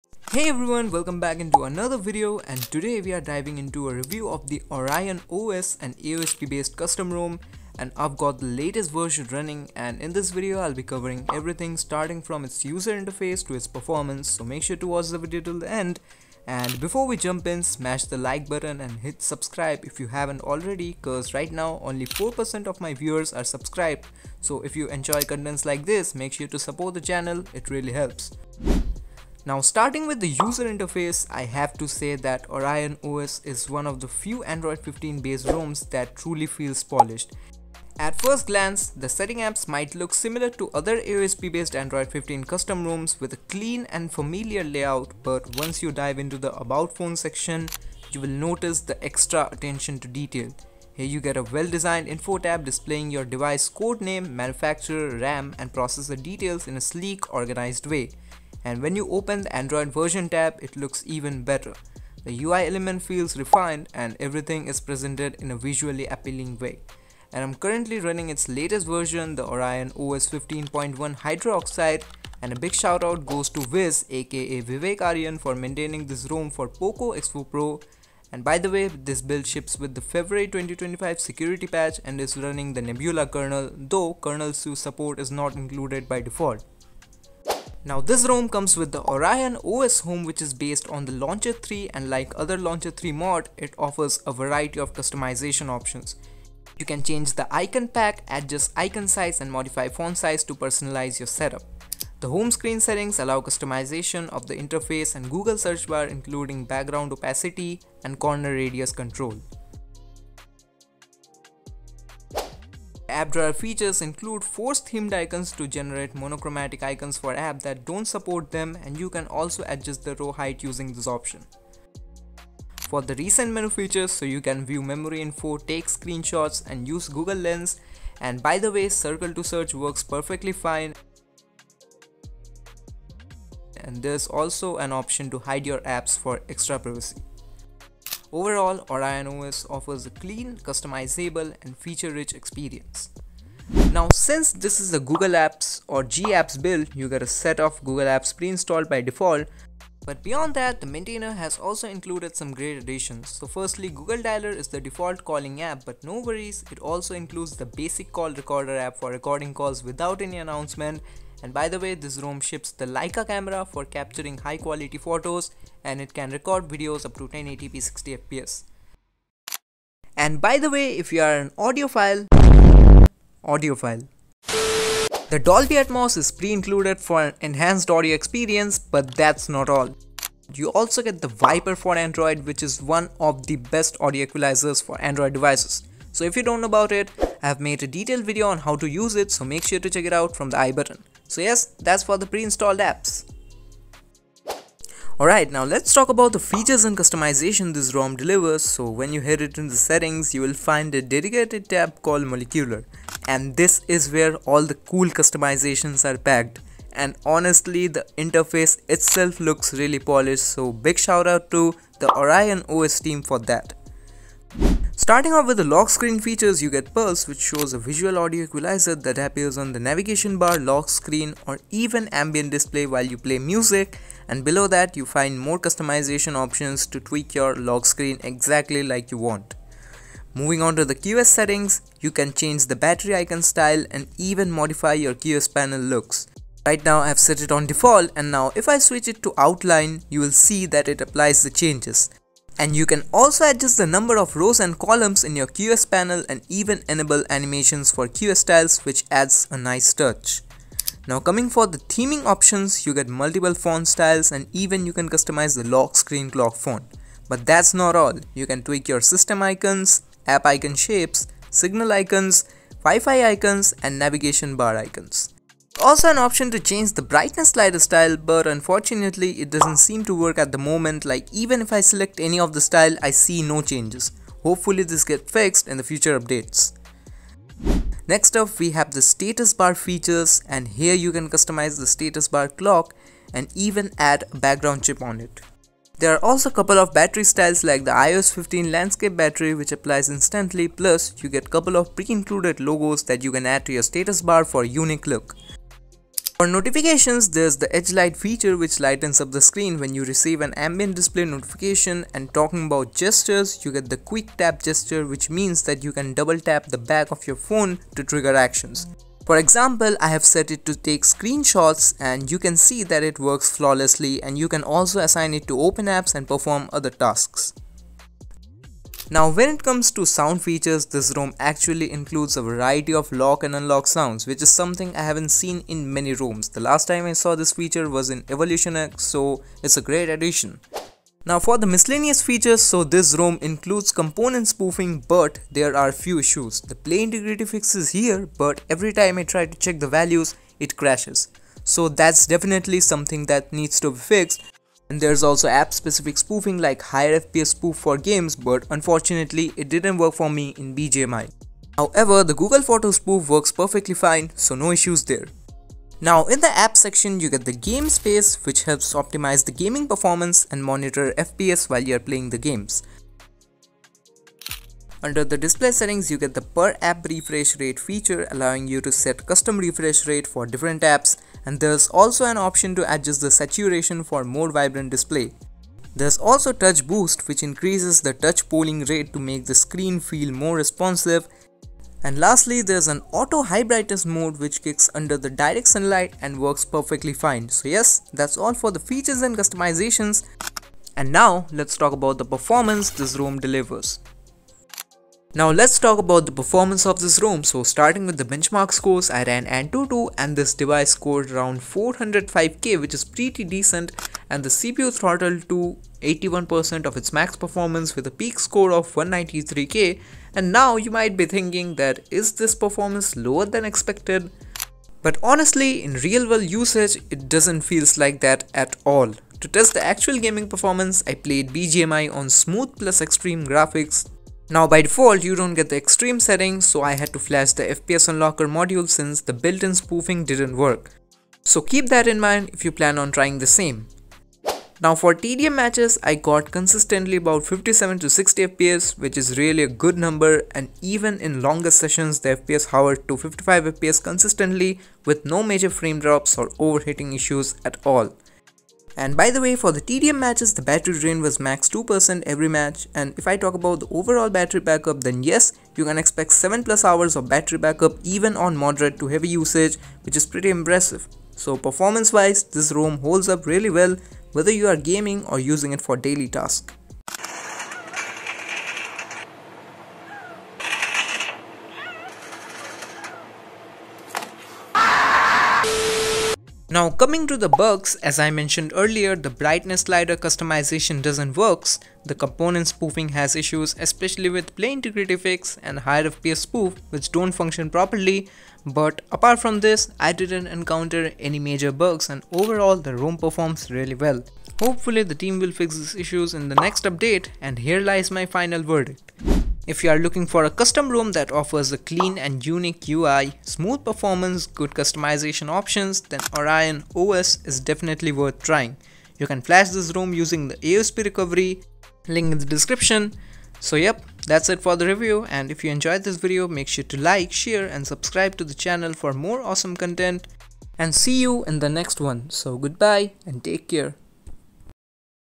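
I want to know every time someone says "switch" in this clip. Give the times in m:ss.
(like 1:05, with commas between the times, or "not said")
3:58.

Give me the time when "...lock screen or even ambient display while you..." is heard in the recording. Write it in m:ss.
3:40.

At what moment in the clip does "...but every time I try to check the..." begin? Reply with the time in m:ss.
5:38.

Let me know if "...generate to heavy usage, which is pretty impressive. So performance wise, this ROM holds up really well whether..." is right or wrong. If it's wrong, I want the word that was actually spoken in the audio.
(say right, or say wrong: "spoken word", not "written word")
wrong: "moderate", not "generate".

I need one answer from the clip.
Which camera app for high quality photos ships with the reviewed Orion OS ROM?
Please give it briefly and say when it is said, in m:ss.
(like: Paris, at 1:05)
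Leica camera, at 2:42.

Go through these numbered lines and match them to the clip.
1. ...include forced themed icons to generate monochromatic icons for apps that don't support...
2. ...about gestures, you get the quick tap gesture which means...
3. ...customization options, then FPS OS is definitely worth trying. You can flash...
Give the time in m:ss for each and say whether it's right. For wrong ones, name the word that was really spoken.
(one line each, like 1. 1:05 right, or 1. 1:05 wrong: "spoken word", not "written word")
1. 1:54 right
2. 5:02 right
3. 8:24 wrong: "Orion", not "FPS".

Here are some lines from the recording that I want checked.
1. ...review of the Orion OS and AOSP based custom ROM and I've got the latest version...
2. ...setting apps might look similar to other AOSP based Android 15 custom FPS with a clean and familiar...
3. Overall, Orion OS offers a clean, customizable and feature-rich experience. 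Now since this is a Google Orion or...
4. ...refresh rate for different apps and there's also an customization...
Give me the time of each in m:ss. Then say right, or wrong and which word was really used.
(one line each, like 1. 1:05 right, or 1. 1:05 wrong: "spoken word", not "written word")
1. 0:03 right
2. 0:39 wrong: "ROMs", not "FPS"
3. 2:18 wrong: "Apps", not "Orion"
4. 6:09 wrong: "option", not "customization".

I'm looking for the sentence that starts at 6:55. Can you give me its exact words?
But honestly, in real world usage, it doesn't feels like that at all.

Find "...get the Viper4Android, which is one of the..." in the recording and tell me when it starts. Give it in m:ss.
3:01.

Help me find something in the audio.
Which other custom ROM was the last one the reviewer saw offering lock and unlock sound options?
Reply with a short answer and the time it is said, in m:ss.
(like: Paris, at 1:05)
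Evolution X, at 5:28.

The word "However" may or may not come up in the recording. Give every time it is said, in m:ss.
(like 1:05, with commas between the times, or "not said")
5:51.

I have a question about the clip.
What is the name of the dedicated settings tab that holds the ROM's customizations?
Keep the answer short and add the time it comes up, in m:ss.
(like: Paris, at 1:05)
molecular, at 3:22.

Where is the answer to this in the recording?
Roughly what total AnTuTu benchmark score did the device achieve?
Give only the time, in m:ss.
6:41.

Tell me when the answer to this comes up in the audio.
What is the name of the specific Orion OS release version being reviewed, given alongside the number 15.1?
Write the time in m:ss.
1:11.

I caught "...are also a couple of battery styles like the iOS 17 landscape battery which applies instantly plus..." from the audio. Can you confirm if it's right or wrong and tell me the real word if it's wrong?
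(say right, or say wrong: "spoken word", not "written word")
wrong: "15", not "17".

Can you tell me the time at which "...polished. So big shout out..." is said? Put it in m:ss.
3:29.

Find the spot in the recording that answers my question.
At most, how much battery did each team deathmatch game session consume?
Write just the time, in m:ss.
7:31.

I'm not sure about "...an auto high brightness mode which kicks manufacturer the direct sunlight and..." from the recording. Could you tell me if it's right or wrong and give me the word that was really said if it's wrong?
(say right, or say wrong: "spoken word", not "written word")
wrong: "under", not "manufacturer".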